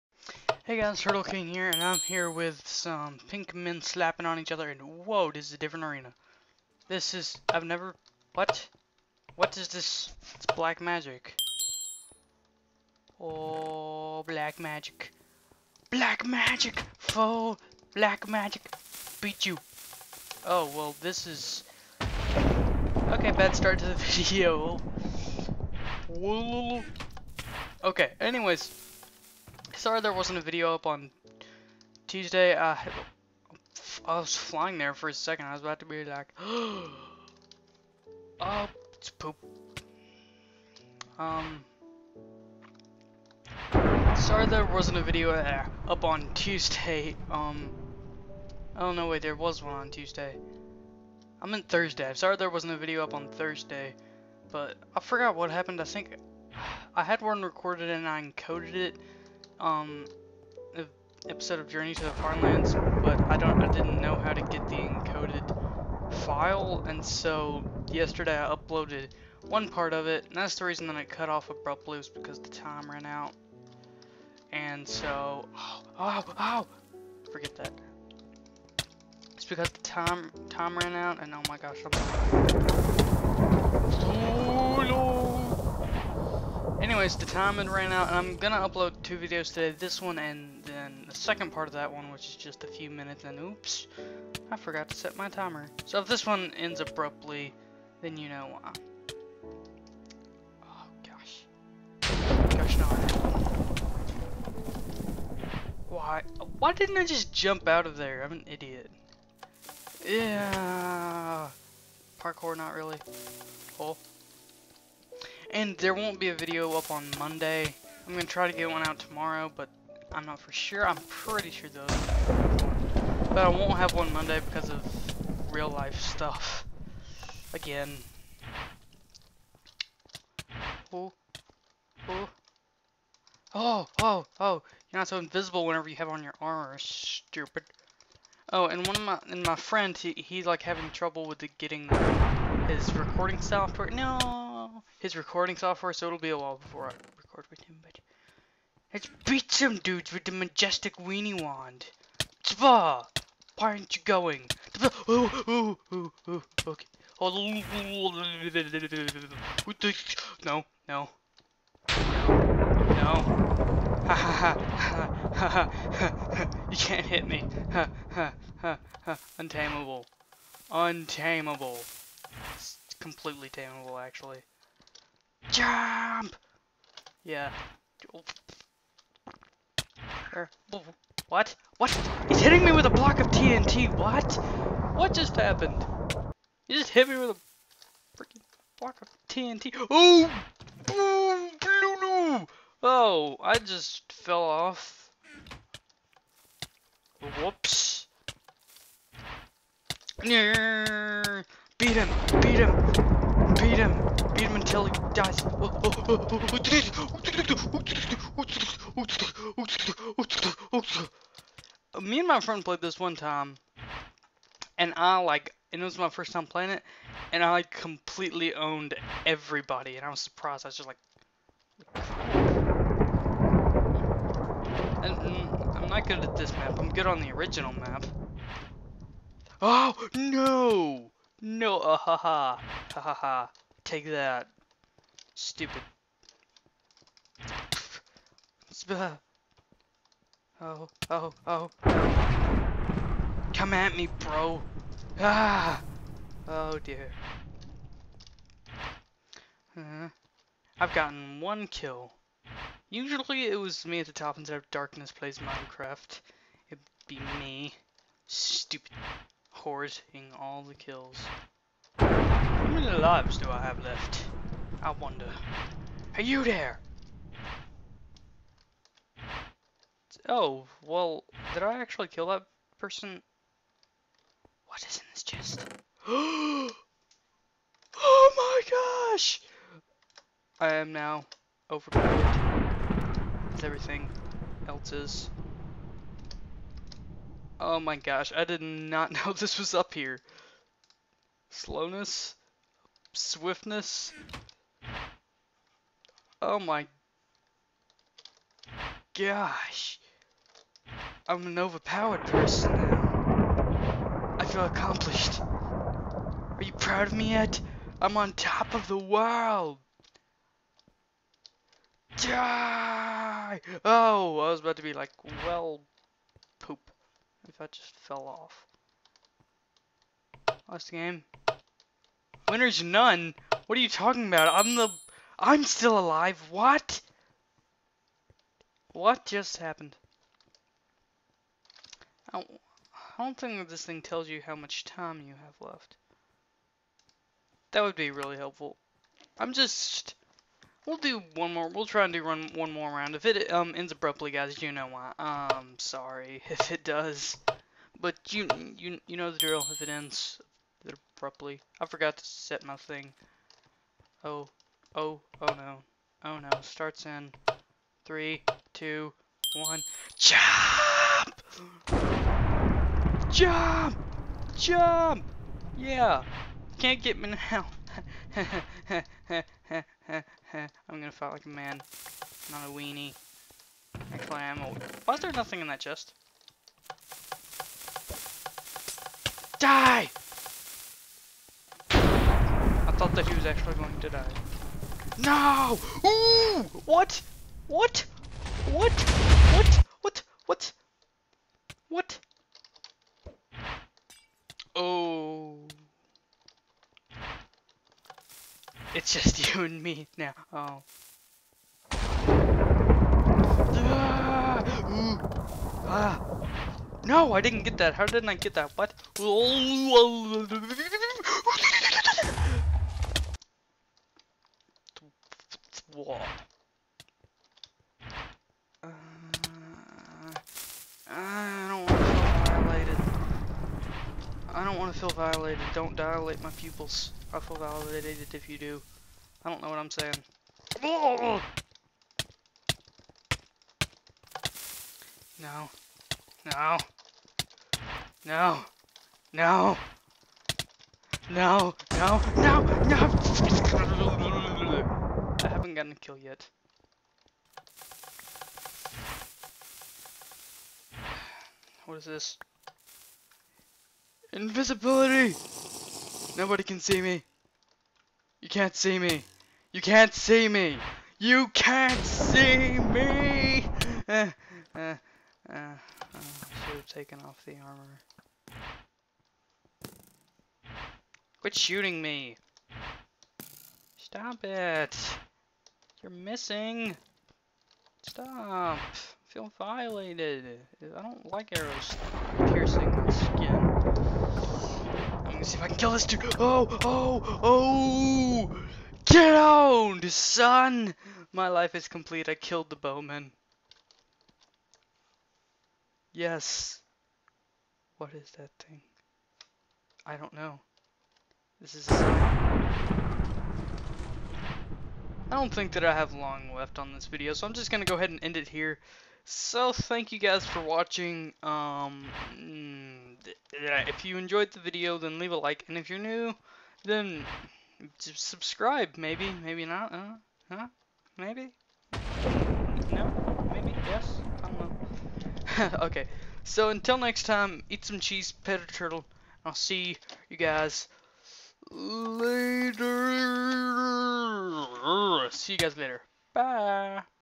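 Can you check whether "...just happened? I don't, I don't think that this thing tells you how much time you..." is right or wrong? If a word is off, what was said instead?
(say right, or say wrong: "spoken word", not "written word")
right.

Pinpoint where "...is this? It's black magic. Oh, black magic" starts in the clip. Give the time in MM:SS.
00:09.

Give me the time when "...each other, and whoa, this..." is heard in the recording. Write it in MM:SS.
00:04.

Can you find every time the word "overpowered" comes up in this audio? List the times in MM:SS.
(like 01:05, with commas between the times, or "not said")
04:41, 05:01.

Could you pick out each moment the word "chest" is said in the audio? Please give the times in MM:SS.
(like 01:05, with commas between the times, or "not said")
04:35, 06:15.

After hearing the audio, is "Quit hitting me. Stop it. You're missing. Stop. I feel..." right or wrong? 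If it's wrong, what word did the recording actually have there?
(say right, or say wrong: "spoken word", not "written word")
wrong: "shooting", not "hitting".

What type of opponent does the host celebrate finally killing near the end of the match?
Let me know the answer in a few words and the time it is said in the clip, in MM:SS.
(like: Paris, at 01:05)
the bowman, at 08:12.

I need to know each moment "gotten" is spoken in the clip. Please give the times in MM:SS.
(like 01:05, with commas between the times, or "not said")
04:10, 07:25.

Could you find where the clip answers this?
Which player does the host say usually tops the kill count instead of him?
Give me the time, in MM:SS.
04:14.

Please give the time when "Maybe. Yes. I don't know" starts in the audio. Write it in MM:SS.
08:43.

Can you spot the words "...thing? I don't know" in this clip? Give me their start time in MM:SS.
08:18.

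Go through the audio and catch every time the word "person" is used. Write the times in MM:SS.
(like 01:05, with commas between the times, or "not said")
04:32, 05:02.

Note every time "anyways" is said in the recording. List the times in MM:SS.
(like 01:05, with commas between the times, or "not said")
00:28, 01:27.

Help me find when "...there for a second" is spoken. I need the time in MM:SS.
00:34.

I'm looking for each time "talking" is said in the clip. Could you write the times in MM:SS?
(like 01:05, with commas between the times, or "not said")
05:23.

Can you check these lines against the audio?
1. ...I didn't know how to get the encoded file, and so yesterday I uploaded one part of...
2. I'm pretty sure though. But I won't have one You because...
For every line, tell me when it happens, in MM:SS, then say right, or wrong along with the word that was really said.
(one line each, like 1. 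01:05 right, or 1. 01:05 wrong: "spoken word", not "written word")
1. 01:03 right
2. 02:00 wrong: "Monday", not "You".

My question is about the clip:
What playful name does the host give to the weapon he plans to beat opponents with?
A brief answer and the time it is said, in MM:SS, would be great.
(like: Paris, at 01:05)
majestic weenie wand, at 02:30.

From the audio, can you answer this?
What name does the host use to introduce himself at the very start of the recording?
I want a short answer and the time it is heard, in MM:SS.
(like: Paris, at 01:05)
Turtle King, at 00:01.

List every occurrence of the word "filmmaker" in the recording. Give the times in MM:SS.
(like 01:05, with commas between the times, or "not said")
not said.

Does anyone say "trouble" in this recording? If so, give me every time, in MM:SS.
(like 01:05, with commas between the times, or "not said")
02:20.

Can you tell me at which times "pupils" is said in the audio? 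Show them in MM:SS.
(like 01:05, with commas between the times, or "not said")
07:06.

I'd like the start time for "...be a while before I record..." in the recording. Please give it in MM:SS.
02:26.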